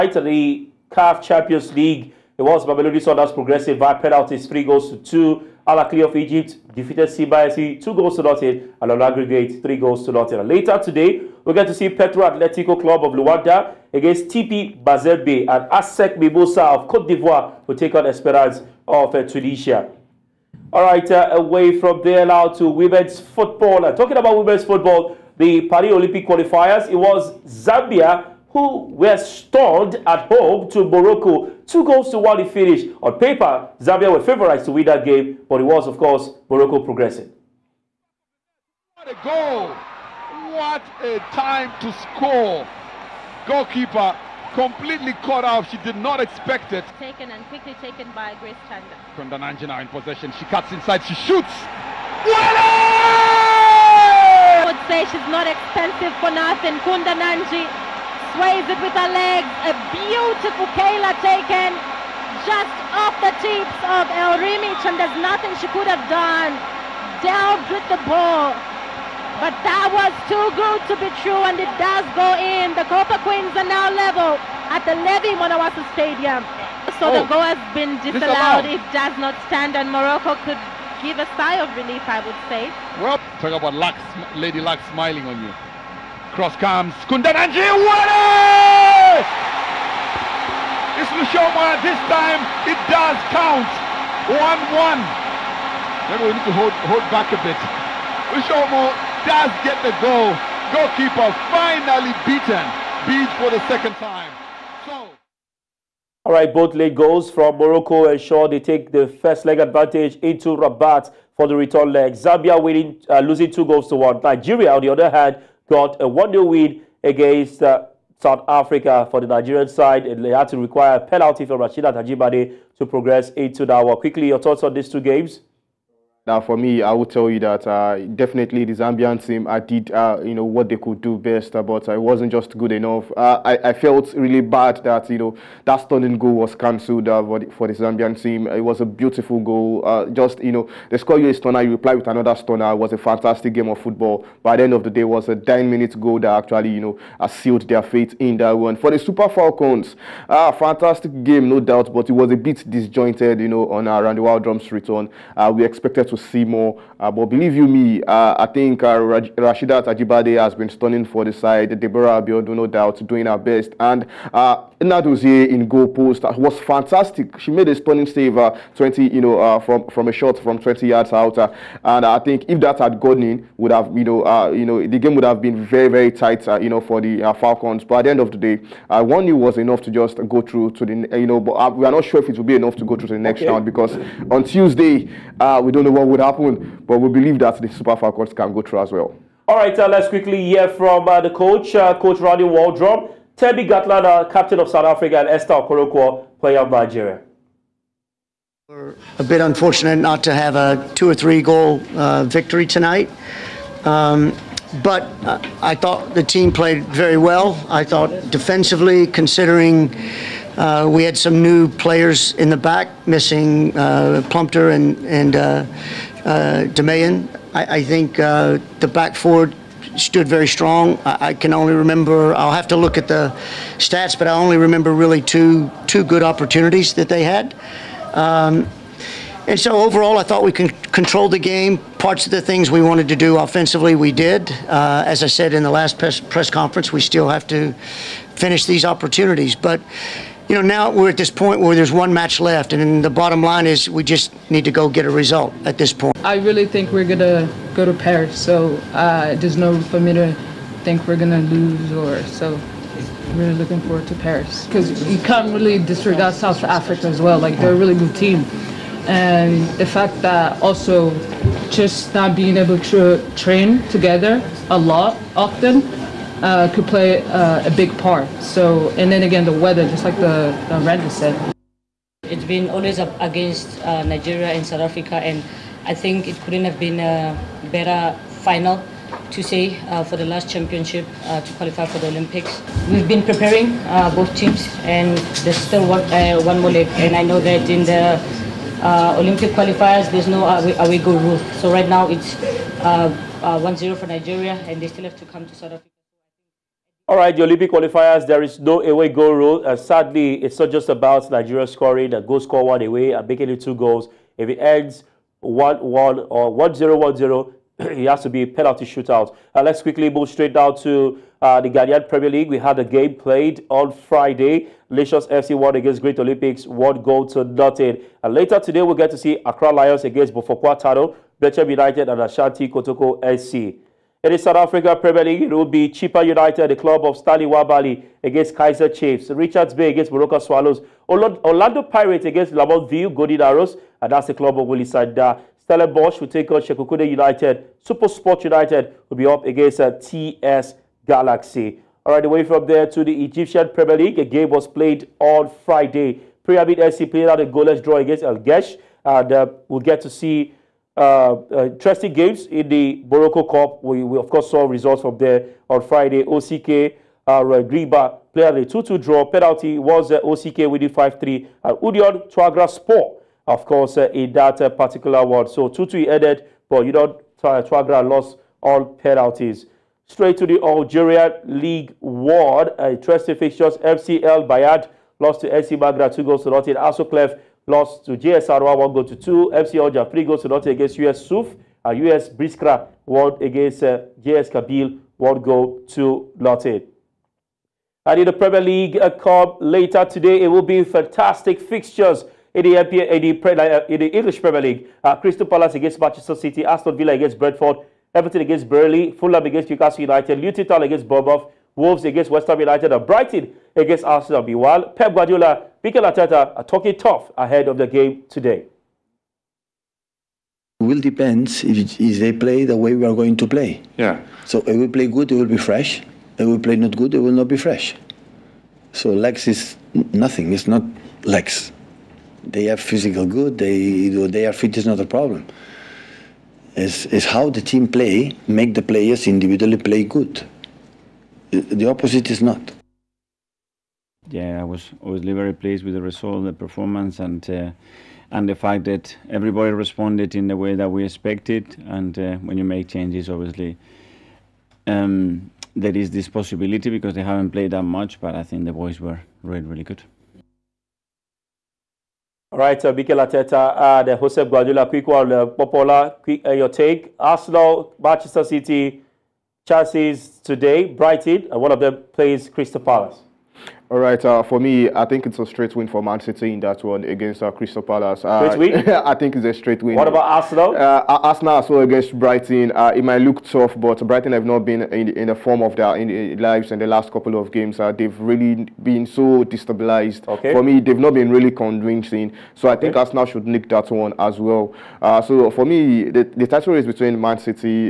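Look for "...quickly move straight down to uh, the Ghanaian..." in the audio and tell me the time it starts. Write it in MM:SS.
05:09.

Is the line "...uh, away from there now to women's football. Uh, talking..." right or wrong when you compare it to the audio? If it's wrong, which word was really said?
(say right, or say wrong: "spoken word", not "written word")
right.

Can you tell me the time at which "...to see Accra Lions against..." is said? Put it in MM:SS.
05:19.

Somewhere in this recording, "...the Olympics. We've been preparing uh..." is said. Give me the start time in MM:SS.
04:41.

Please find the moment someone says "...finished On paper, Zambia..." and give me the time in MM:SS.
00:32.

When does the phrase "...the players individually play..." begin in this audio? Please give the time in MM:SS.
07:08.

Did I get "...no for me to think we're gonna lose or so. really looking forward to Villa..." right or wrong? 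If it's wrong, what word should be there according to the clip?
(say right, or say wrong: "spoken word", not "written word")
wrong: "Paris", not "Villa".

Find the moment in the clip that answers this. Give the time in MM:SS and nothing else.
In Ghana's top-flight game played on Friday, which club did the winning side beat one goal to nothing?
05:16.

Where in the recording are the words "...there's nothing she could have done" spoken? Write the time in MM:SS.
01:04.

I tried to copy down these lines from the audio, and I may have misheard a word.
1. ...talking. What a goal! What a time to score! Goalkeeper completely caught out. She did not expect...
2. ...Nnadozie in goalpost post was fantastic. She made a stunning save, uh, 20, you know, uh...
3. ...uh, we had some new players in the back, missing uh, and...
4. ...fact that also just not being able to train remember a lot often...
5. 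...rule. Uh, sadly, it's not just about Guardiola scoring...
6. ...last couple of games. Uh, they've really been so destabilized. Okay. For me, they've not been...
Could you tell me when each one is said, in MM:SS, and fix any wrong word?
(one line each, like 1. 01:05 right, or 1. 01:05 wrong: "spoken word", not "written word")
1. 00:36 wrong: "progressing", not "talking"
2. 02:44 right
3. 03:30 right
4. 04:19 wrong: "together", not "remember"
5. 04:59 wrong: "Nigeria", not "Guardiola"
6. 07:56 right.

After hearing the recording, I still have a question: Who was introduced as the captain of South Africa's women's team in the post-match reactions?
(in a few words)
Thembi Kgatlana.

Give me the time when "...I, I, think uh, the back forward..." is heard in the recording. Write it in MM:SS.
03:37.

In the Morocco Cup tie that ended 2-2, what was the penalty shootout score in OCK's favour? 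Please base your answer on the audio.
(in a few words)
5-3.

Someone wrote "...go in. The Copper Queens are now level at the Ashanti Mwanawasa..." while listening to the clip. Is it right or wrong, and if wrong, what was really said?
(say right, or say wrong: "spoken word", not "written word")
wrong: "Levy", not "Ashanti".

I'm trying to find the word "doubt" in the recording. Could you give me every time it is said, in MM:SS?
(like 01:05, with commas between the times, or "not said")
02:31, 02:42.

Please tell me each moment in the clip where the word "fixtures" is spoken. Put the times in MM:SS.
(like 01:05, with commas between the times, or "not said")
06:13, 06:31.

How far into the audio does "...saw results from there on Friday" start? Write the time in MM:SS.
05:54.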